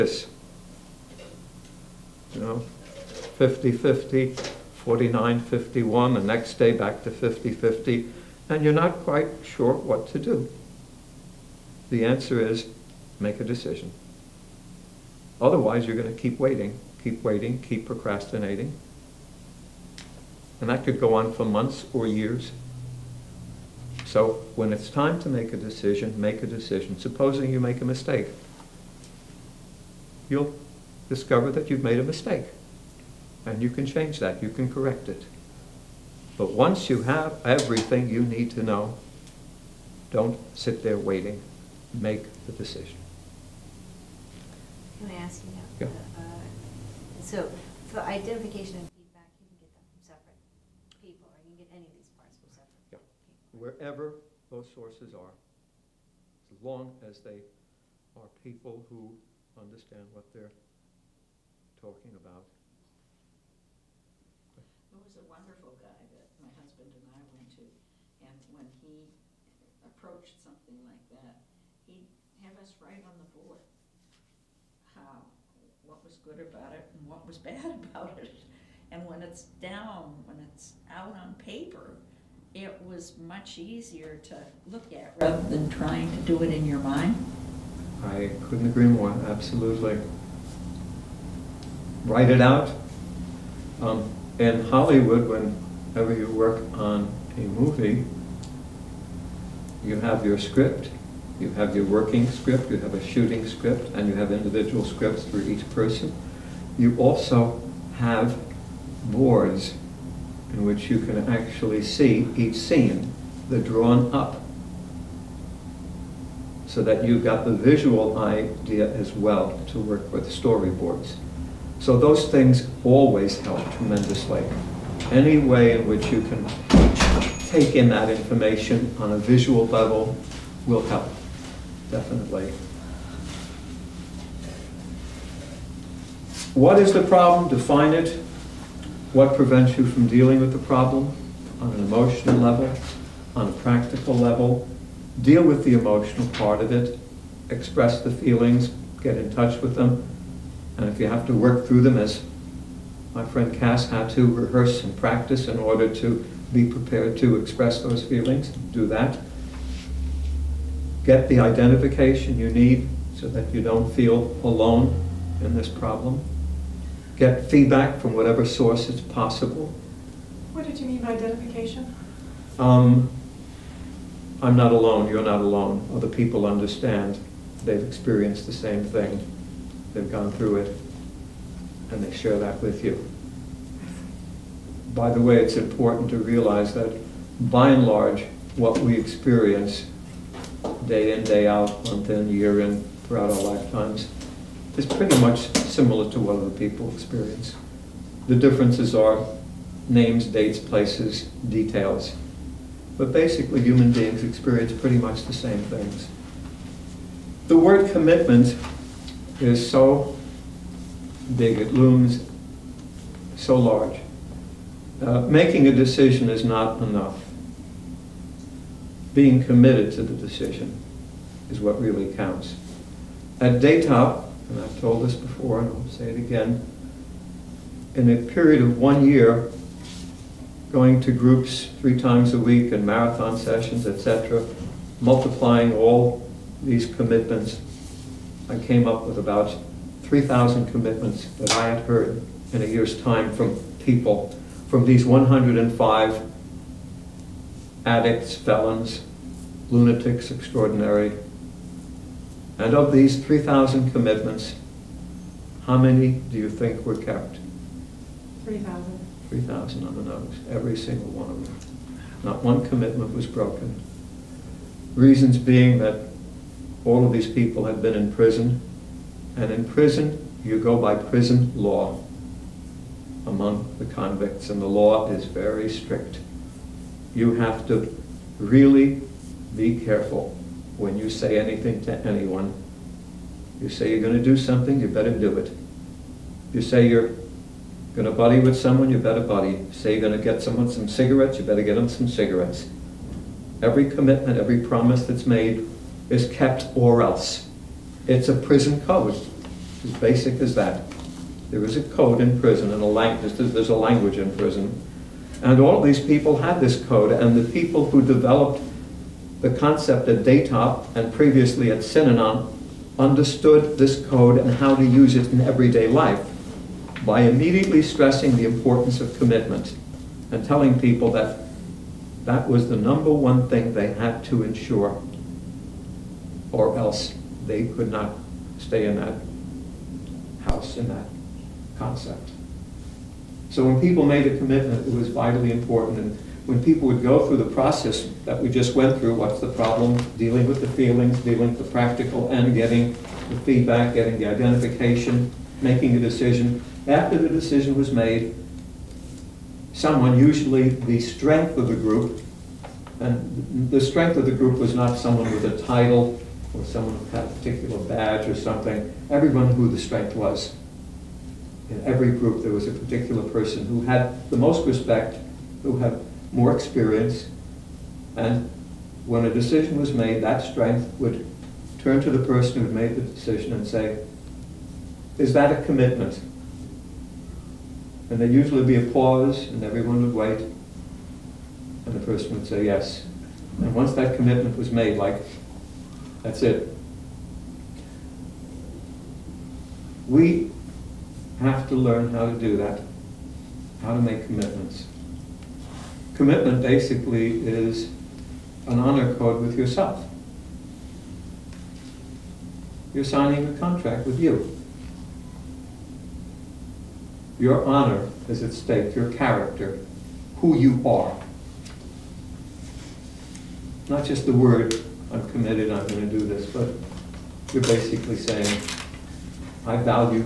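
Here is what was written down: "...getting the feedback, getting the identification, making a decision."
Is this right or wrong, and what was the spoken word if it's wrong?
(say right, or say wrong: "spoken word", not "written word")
right.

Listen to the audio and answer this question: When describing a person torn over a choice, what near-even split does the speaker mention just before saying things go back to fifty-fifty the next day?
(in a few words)
49-51.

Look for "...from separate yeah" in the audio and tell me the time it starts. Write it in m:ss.
0:52.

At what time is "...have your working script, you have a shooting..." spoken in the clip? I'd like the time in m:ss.
1:41.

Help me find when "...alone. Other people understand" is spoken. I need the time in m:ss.
2:55.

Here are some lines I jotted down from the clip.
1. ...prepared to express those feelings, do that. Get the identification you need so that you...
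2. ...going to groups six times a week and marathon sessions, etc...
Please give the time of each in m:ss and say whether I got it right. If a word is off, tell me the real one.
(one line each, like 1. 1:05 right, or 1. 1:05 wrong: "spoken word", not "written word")
1. 2:36 right
2. 3:50 wrong: "three", not "six".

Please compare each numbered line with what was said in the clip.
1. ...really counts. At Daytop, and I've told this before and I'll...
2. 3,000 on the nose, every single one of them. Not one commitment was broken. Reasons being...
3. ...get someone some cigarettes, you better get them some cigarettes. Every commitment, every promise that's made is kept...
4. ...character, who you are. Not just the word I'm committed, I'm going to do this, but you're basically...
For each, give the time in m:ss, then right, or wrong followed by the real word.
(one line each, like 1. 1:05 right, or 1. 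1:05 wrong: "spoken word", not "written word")
1. 3:41 right
2. 4:19 right
3. 4:50 right
4. 6:49 right.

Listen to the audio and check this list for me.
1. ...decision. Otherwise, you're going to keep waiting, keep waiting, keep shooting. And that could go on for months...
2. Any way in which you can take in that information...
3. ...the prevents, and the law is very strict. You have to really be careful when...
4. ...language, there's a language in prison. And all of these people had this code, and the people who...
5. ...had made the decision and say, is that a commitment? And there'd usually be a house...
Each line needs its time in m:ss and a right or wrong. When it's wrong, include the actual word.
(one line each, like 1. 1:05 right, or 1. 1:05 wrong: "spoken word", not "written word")
1. 0:13 wrong: "procrastinating", not "shooting"
2. 2:05 right
3. 4:33 wrong: "convicts", not "prevents"
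4. 5:02 right
5. 6:12 wrong: "pause", not "house".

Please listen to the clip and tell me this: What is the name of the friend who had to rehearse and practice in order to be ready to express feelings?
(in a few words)
Cass.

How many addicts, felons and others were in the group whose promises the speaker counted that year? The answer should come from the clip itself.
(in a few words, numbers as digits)
105.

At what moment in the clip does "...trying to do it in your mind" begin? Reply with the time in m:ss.
1:25.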